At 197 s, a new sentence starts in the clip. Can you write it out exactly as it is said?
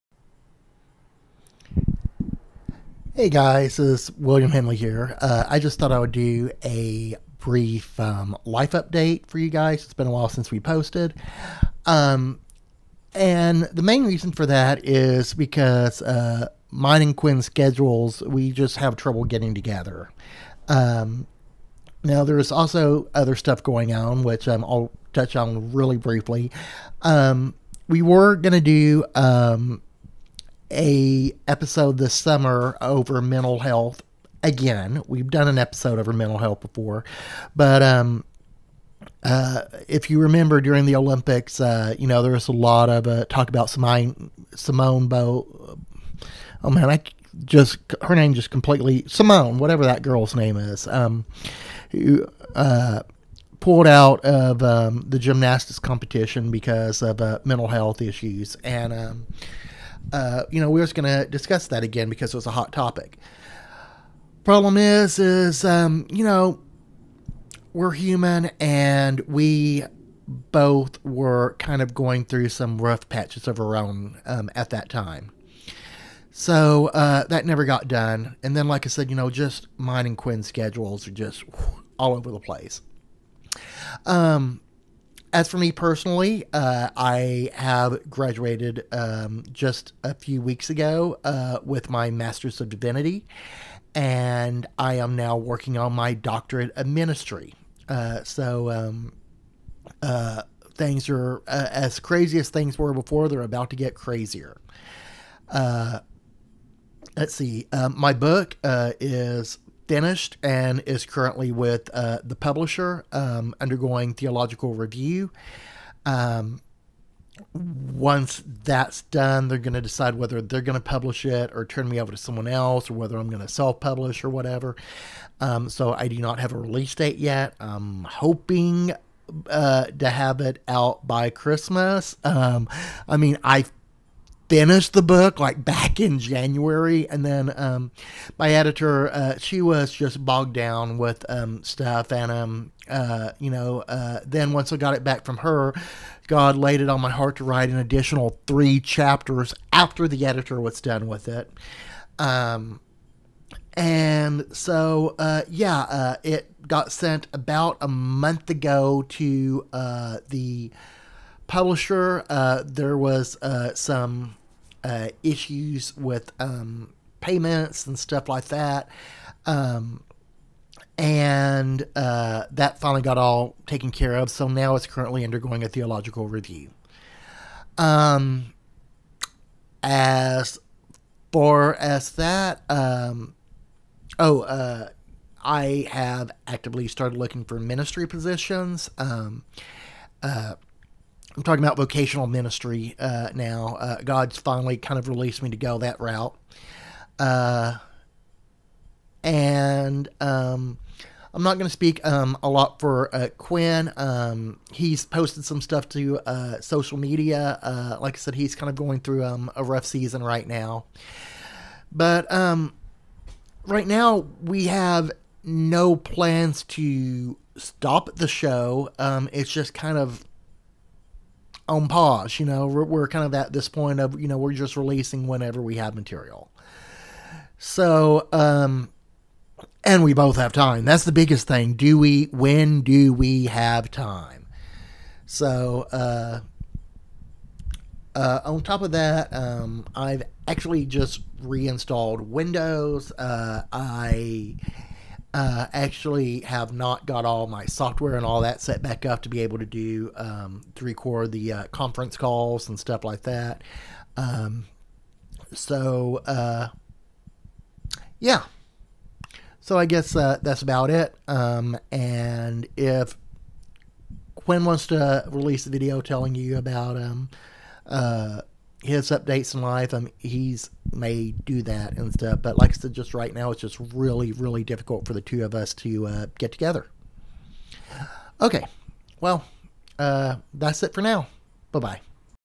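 Uh, and um, I'm not going to speak um, a lot for uh, Quinn.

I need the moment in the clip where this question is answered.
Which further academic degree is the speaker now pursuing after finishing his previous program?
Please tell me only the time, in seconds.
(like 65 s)
96 s.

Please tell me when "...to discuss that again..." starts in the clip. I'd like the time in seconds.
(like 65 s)
61 s.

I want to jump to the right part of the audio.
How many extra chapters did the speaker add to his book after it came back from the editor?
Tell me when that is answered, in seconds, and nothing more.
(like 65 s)
148 s.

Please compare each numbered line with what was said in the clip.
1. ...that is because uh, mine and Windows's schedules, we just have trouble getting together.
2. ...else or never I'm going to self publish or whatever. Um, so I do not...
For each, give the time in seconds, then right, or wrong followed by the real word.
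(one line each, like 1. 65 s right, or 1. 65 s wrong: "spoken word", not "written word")
1. 14 s wrong: "Quinn", not "Windows"
2. 122 s wrong: "whether", not "never".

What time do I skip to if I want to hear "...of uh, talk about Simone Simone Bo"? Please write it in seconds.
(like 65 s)
42 s.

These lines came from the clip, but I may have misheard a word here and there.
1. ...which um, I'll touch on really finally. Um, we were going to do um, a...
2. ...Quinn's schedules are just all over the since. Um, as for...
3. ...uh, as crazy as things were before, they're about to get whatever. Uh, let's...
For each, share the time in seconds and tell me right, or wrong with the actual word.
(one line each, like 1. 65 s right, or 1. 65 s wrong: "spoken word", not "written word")
1. 24 s wrong: "briefly", not "finally"
2. 80 s wrong: "place", not "since"
3. 101 s wrong: "crazier", not "whatever".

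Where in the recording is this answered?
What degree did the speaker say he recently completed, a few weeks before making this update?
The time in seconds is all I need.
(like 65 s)
92 s.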